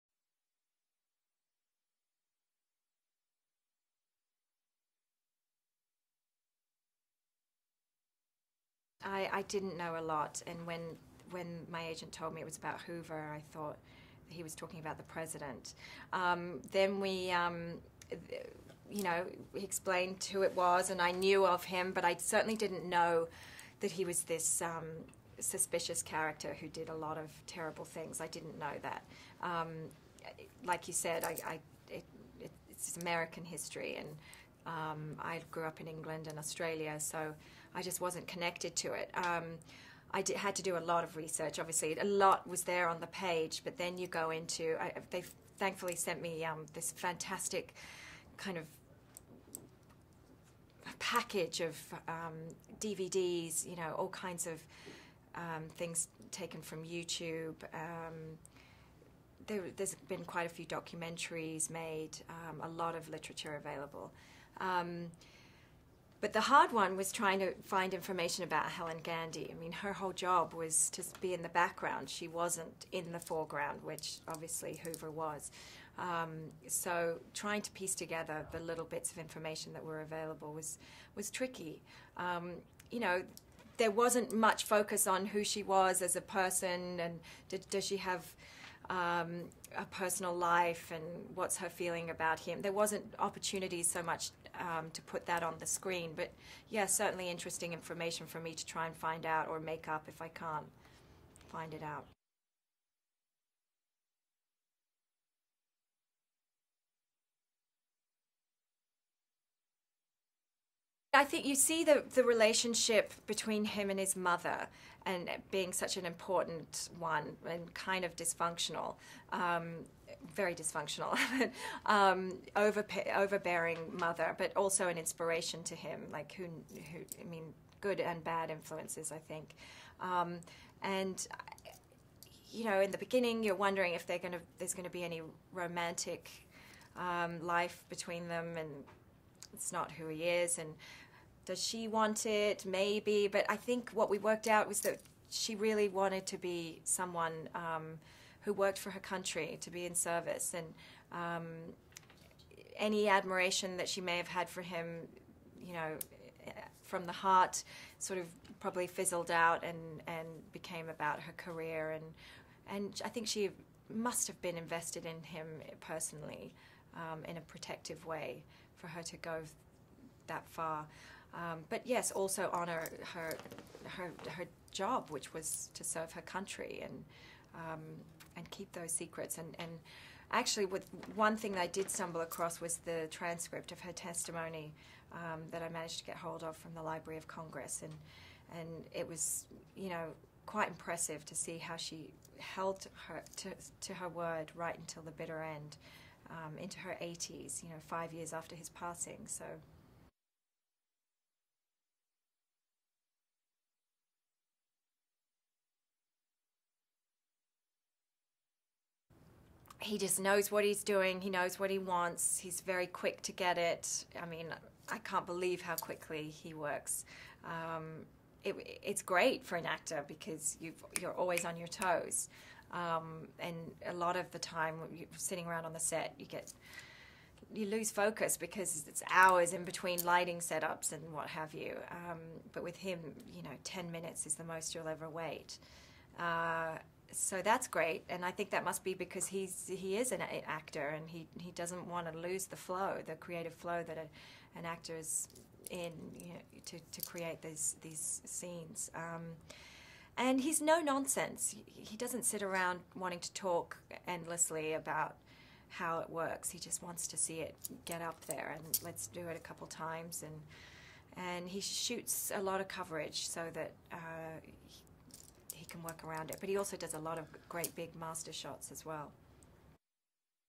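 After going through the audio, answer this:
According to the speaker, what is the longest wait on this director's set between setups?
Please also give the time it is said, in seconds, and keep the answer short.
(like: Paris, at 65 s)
10 minutes, at 233 s.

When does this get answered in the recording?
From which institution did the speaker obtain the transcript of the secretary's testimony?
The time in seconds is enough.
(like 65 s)
186 s.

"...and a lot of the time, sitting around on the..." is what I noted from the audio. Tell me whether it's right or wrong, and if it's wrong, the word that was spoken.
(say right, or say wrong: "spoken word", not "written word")
right.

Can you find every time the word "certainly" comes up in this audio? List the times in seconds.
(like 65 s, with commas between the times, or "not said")
22 s, 96 s.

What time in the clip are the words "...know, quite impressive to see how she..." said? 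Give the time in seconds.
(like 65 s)
189 s.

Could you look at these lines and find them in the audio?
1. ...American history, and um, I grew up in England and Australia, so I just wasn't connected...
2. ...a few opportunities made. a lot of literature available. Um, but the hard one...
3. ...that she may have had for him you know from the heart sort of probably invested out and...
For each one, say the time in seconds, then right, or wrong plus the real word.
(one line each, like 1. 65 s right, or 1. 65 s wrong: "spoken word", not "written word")
1. 32 s right
2. 60 s wrong: "documentaries", not "opportunities"
3. 153 s wrong: "fizzled", not "invested".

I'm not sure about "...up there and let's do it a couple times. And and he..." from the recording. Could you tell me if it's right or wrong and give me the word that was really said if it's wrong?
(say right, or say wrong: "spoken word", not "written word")
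right.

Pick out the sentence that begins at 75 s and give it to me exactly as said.
Um, so trying to piece together the little bits of information that were available was was tricky.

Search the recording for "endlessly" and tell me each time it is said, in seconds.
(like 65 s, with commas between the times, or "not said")
254 s.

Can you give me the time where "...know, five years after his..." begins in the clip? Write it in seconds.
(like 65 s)
197 s.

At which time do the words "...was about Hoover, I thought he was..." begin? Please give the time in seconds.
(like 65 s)
12 s.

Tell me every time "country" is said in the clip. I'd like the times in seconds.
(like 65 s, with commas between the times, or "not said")
148 s, 176 s.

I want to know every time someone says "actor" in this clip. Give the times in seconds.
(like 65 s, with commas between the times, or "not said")
219 s, 240 s, 244 s.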